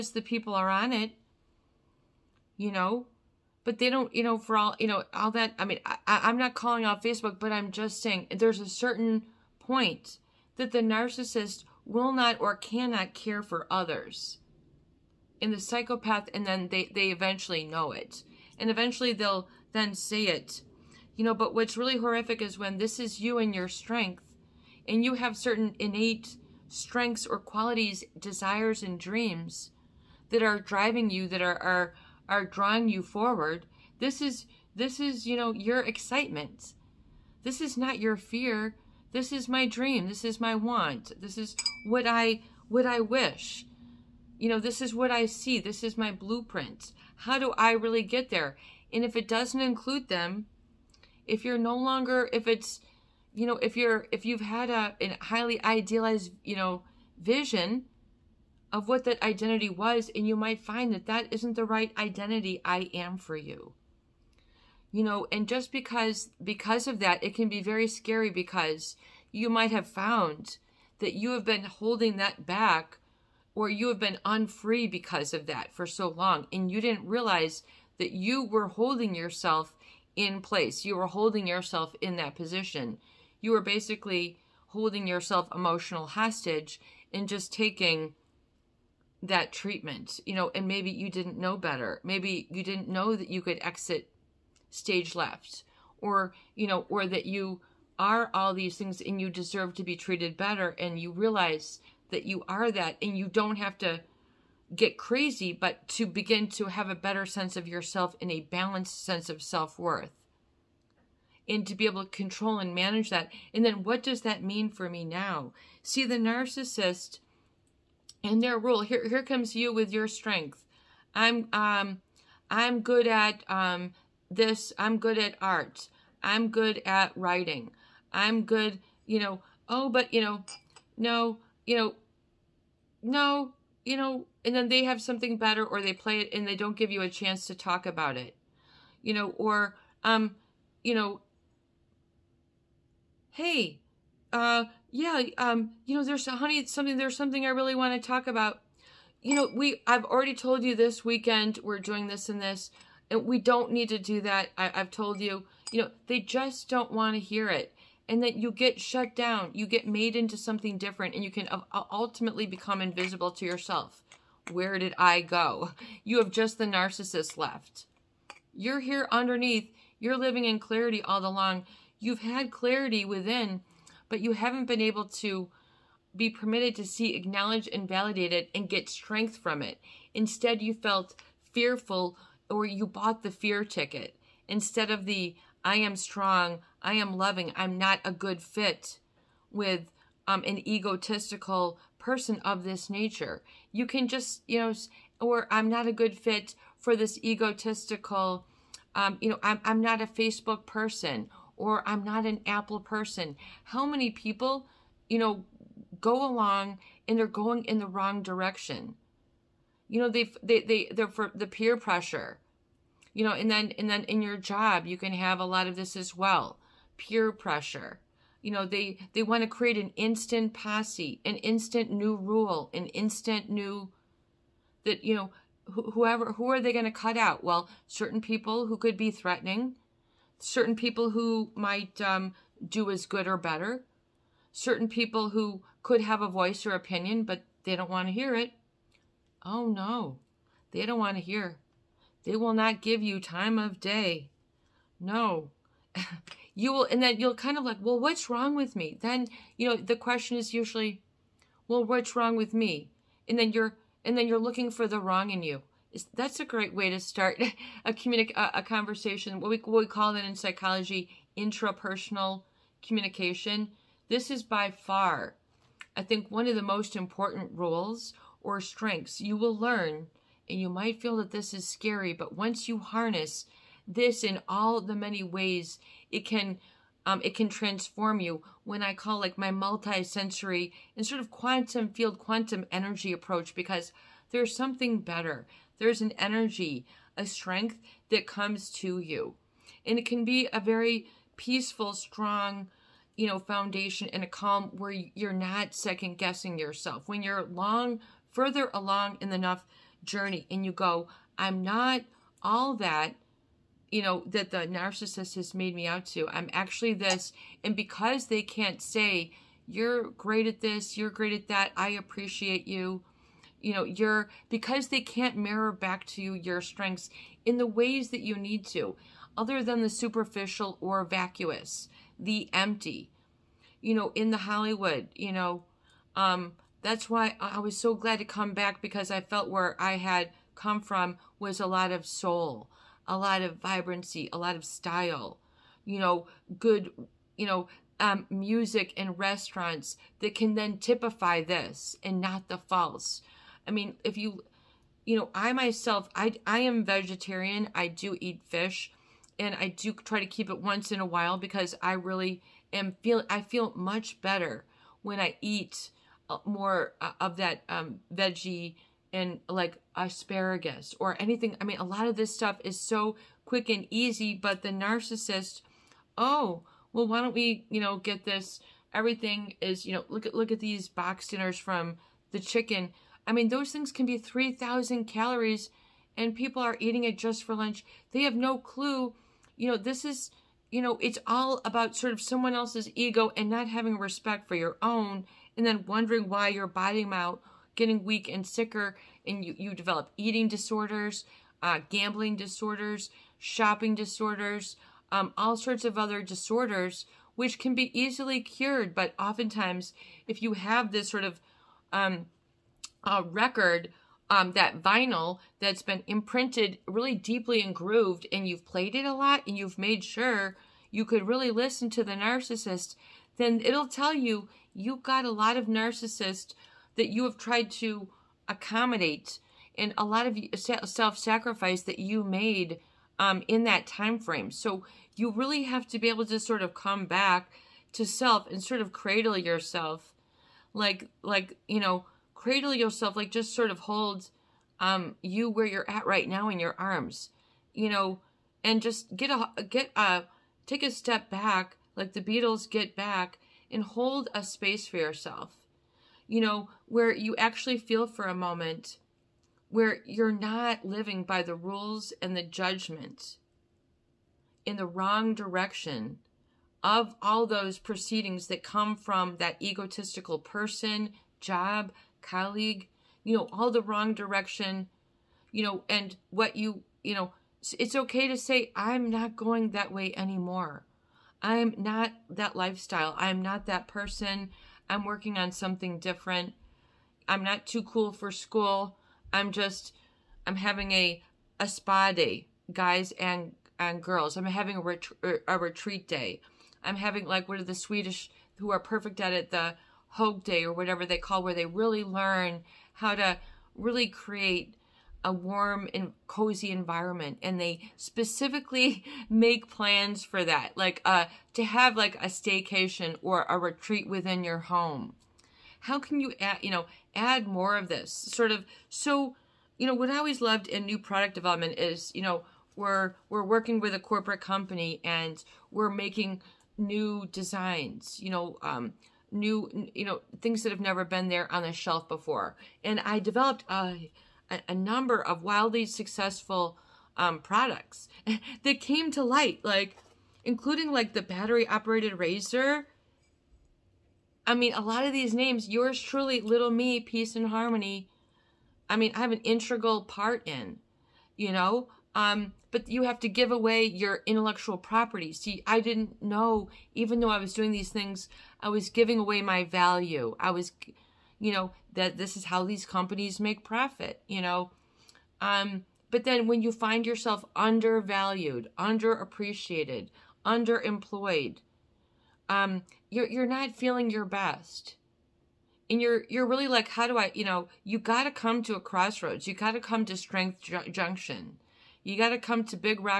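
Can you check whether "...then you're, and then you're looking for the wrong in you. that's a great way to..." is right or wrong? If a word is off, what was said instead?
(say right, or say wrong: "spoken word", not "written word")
right.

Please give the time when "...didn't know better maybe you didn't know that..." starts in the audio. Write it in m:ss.
1:31.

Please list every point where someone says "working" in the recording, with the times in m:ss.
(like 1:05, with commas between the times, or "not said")
7:55, 8:33.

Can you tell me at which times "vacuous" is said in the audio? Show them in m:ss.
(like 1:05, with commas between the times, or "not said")
5:21.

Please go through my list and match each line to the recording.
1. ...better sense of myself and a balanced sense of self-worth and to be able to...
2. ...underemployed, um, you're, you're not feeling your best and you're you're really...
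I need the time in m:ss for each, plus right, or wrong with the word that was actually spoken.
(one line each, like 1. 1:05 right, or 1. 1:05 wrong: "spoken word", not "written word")
1. 1:46 wrong: "yourself", not "myself"
2. 9:20 right.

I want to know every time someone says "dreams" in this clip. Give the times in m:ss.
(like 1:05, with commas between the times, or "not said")
0:29, 0:39.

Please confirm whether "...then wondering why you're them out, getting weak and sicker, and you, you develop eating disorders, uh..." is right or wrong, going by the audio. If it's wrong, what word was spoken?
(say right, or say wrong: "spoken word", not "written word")
right.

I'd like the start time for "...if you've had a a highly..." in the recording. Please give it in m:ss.
0:54.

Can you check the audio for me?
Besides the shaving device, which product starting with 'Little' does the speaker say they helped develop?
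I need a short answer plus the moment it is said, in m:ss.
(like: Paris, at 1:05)
Little Me, at 8:56.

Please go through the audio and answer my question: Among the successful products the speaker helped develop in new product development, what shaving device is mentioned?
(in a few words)
battery operated razor.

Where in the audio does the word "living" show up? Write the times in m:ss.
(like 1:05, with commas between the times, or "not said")
2:50, 7:30.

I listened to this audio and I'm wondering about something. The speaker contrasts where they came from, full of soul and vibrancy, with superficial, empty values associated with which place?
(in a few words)
Hollywood.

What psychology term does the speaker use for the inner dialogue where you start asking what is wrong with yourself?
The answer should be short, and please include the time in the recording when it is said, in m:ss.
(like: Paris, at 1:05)
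intrapersonal communication, at 4:21.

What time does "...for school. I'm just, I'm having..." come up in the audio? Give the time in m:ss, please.
7:58.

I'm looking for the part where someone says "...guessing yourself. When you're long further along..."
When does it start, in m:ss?
4:56.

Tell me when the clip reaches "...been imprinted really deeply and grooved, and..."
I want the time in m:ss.
6:45.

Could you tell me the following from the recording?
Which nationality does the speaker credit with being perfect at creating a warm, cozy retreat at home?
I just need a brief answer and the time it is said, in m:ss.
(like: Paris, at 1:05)
Swedish, at 8:07.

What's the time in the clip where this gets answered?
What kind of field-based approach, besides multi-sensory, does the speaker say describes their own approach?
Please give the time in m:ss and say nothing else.
4:41.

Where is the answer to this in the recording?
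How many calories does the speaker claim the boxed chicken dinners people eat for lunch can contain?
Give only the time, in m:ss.
6:14.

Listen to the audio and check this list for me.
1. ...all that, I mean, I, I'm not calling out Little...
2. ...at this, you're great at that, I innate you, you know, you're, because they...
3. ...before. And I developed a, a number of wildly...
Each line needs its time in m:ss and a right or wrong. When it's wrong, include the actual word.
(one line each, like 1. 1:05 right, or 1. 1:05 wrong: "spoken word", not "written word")
1. 0:05 wrong: "Facebook", not "Little"
2. 5:10 wrong: "appreciate", not "innate"
3. 8:42 right.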